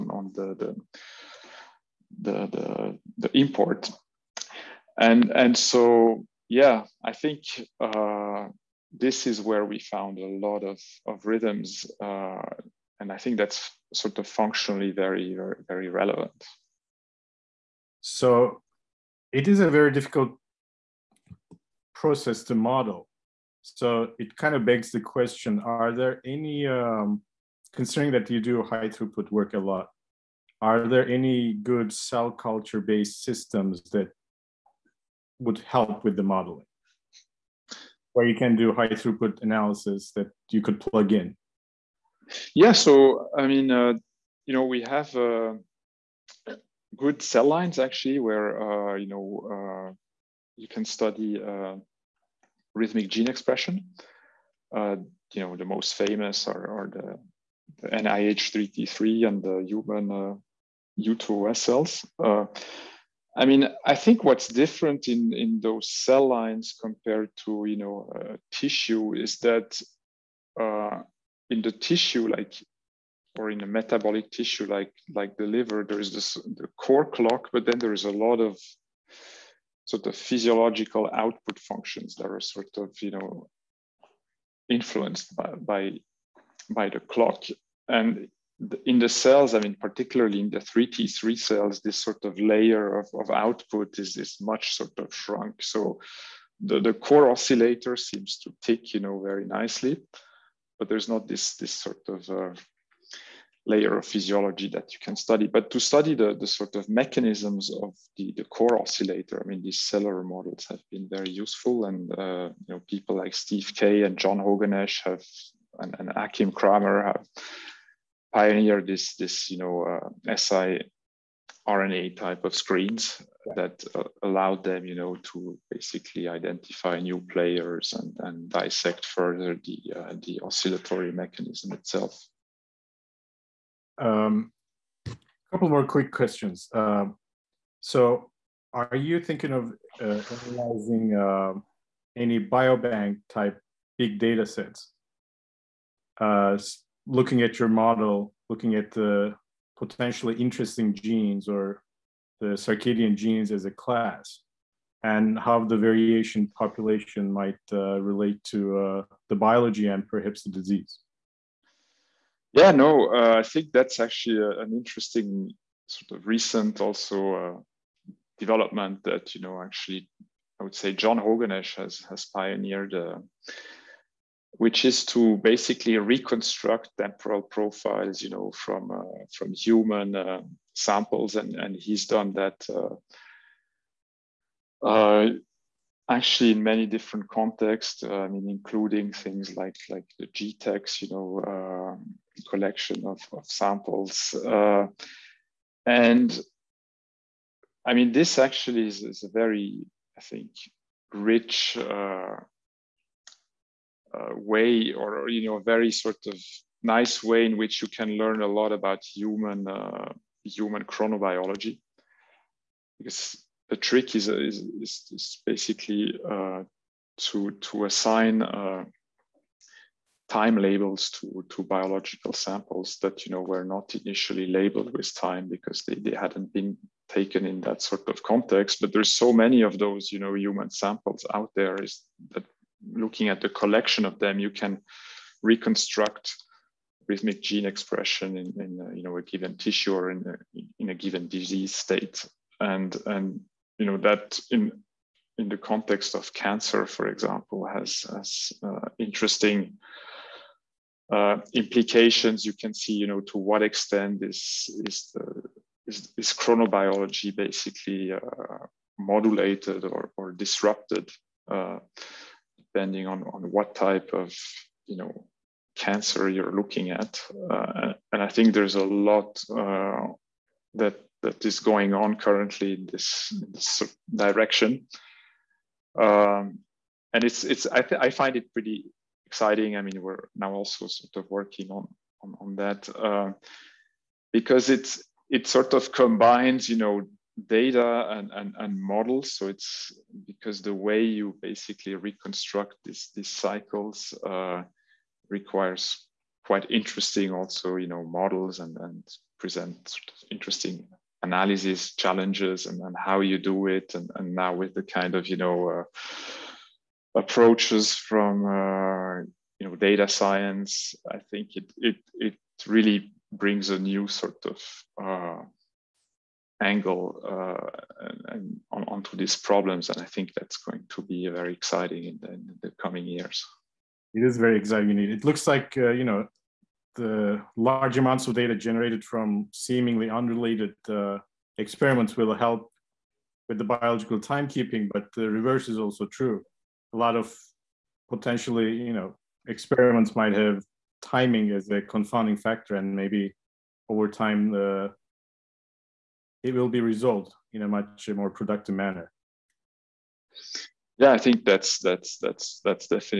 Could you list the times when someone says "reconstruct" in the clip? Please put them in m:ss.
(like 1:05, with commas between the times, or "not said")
2:55, 3:55, 4:51.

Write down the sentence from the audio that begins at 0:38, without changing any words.
Where you can do high throughput analysis that you could plug in?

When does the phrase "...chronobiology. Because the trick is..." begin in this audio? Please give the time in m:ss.
3:30.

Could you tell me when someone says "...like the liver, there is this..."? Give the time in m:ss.
1:15.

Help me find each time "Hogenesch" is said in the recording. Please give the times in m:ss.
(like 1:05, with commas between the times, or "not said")
1:54, 2:51.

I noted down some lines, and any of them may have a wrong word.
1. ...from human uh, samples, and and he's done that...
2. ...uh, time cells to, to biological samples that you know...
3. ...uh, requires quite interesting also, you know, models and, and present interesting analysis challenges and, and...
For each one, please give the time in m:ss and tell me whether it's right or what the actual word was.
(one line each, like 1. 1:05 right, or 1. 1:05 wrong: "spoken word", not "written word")
1. 2:59 right
2. 3:38 wrong: "labels", not "cells"
3. 4:54 right.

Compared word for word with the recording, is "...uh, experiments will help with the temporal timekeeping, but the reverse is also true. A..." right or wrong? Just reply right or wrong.
wrong.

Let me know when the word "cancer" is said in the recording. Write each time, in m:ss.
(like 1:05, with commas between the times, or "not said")
4:06, 4:25.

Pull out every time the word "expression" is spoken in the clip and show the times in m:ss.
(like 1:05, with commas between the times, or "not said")
0:53, 3:57.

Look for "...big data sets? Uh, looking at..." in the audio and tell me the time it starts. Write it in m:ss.
2:23.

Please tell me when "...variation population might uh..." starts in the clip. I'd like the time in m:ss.
2:35.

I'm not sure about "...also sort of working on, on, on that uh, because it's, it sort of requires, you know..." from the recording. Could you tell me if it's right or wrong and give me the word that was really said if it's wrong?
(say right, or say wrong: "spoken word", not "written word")
wrong: "combines", not "requires".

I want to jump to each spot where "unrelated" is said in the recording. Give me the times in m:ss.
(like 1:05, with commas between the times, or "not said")
5:30.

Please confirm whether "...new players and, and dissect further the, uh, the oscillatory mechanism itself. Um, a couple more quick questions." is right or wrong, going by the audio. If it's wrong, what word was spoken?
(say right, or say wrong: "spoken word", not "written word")
right.